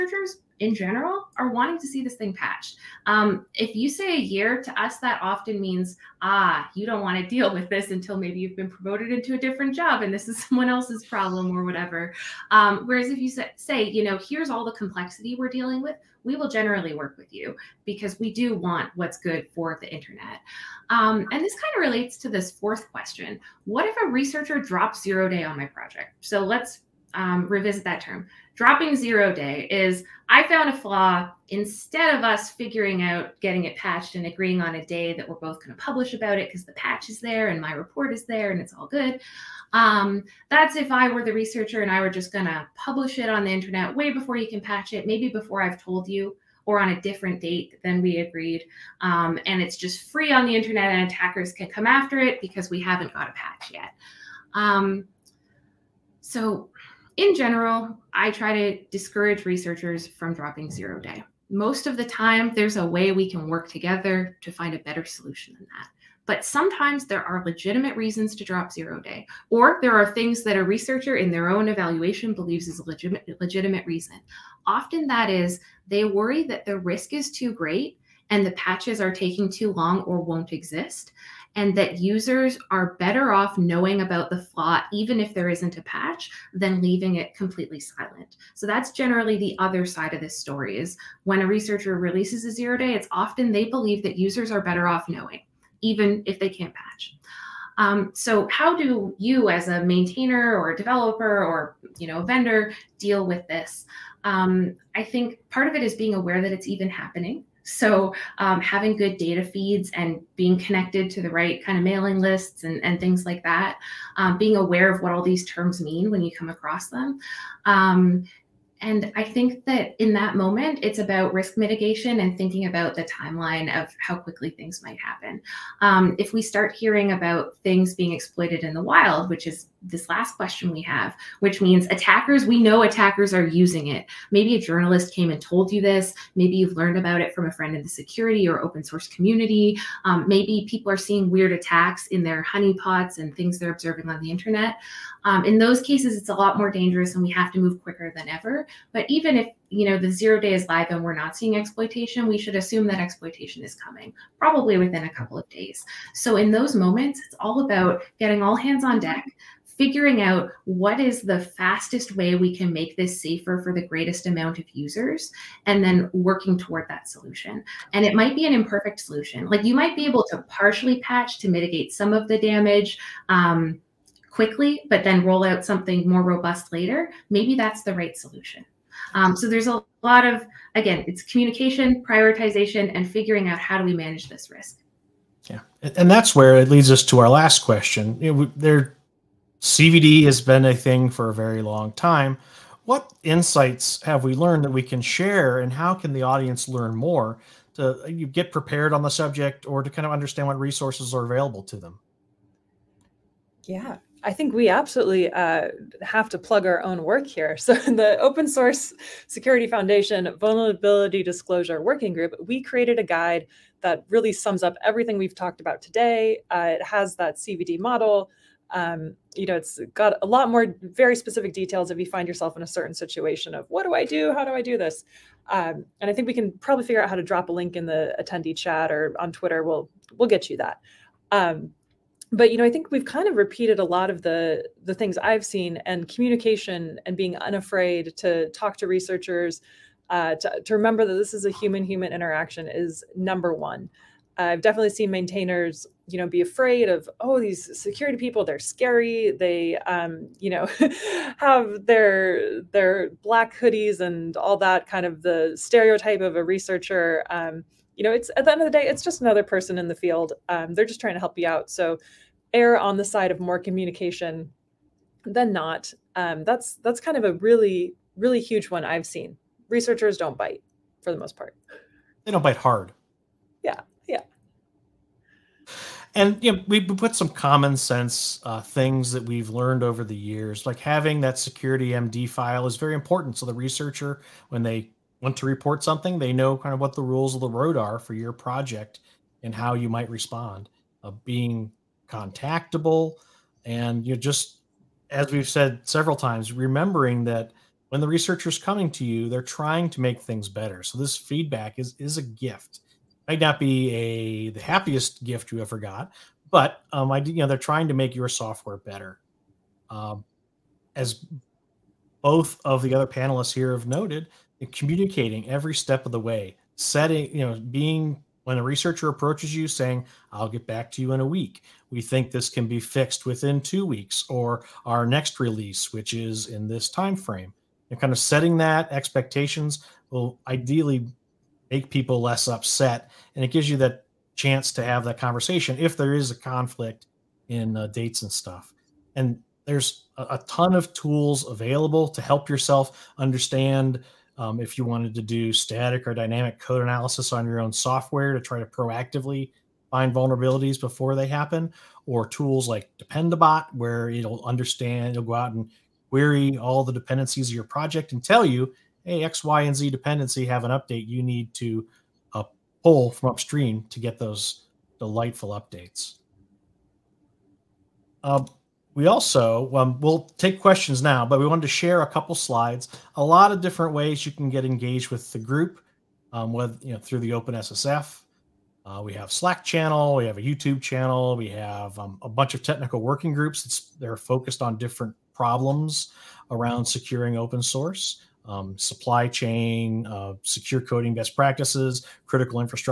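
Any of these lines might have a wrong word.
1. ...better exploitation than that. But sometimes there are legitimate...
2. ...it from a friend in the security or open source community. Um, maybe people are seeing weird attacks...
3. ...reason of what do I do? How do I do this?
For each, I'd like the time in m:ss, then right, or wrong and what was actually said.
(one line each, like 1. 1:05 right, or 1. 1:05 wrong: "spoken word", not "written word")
1. 1:04 wrong: "solution", not "exploitation"
2. 2:17 right
3. 3:42 wrong: "situation", not "reason".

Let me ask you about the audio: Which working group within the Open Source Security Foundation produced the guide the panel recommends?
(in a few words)
Vulnerability Disclosure Working Group.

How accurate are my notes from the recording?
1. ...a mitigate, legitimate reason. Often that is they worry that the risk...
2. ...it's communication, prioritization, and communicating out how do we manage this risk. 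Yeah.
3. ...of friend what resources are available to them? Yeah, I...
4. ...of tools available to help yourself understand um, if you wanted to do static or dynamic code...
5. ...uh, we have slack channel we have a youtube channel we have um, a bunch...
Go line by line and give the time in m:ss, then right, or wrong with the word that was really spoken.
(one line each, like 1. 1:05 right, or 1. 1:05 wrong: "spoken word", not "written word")
1. 1:12 wrong: "legitimate", not "mitigate"
2. 3:01 wrong: "figuring", not "communicating"
3. 3:20 wrong: "understand", not "friend"
4. 5:40 right
5. 6:18 right.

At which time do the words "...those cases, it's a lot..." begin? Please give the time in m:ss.
2:25.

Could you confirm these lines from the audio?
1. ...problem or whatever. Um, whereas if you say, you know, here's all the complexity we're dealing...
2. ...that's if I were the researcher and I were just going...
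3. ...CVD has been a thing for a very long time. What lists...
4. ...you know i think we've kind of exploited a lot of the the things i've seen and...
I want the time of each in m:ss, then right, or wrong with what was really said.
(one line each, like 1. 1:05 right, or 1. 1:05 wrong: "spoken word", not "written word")
1. 0:11 right
2. 0:40 right
3. 3:09 wrong: "insights", not "lists"
4. 3:52 wrong: "repeated", not "exploited".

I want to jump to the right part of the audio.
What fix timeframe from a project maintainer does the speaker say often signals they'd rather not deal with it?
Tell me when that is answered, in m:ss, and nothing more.
0:04.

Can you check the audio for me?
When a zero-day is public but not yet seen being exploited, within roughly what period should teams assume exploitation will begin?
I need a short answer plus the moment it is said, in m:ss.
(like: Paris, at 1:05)
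A couple of days, at 2:35.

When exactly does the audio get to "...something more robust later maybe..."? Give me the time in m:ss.
2:55.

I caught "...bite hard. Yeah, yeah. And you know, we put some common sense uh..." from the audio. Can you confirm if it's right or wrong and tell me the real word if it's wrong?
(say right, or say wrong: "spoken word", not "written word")
right.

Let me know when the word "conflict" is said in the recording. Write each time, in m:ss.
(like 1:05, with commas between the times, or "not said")
5:36.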